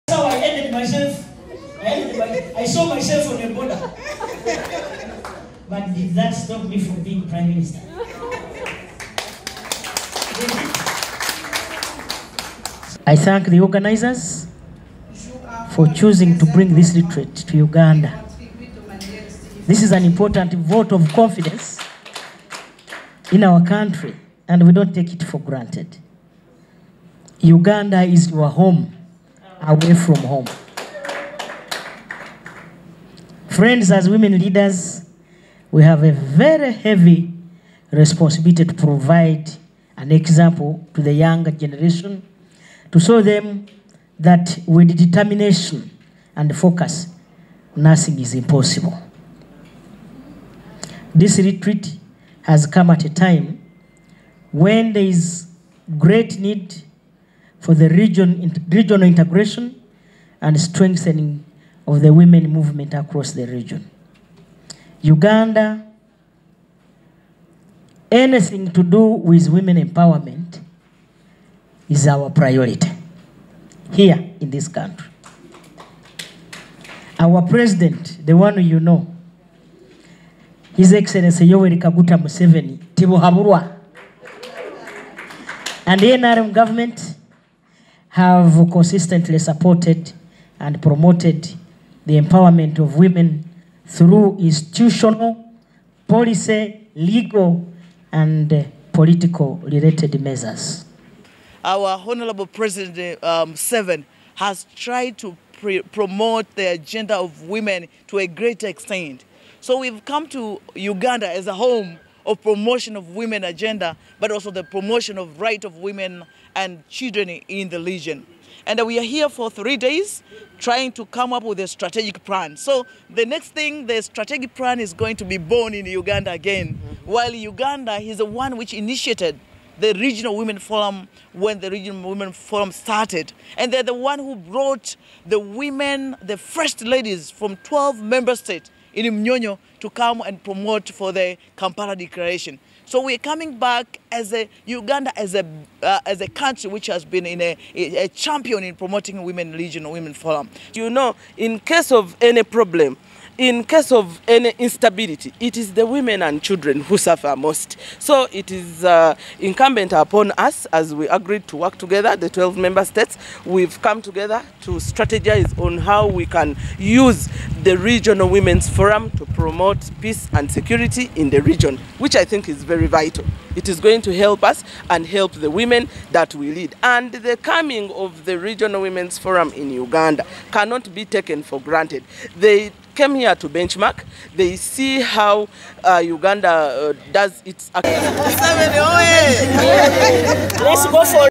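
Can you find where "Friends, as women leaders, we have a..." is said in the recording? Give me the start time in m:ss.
0:33.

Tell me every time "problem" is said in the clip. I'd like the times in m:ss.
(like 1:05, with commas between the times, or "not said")
2:32.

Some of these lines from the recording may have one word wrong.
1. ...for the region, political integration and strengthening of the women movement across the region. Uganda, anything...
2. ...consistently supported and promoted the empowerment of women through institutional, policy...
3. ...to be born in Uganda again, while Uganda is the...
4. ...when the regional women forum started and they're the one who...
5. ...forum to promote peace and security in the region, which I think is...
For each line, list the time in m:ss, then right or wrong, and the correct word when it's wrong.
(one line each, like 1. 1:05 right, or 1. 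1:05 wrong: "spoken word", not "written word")
1. 0:57 wrong: "regional", not "political"
2. 1:28 right
3. 2:05 right
4. 2:11 right
5. 2:48 right.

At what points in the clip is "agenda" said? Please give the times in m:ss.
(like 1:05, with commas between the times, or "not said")
1:46, 1:53.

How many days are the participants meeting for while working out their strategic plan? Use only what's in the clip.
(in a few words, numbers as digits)
3.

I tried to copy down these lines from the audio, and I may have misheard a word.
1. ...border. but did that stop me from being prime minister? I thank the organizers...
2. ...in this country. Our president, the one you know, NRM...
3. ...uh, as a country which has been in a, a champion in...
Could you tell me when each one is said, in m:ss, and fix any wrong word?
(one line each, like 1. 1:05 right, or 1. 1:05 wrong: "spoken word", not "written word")
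1. 0:03 right
2. 1:14 wrong: "His", not "NRM"
3. 2:25 right.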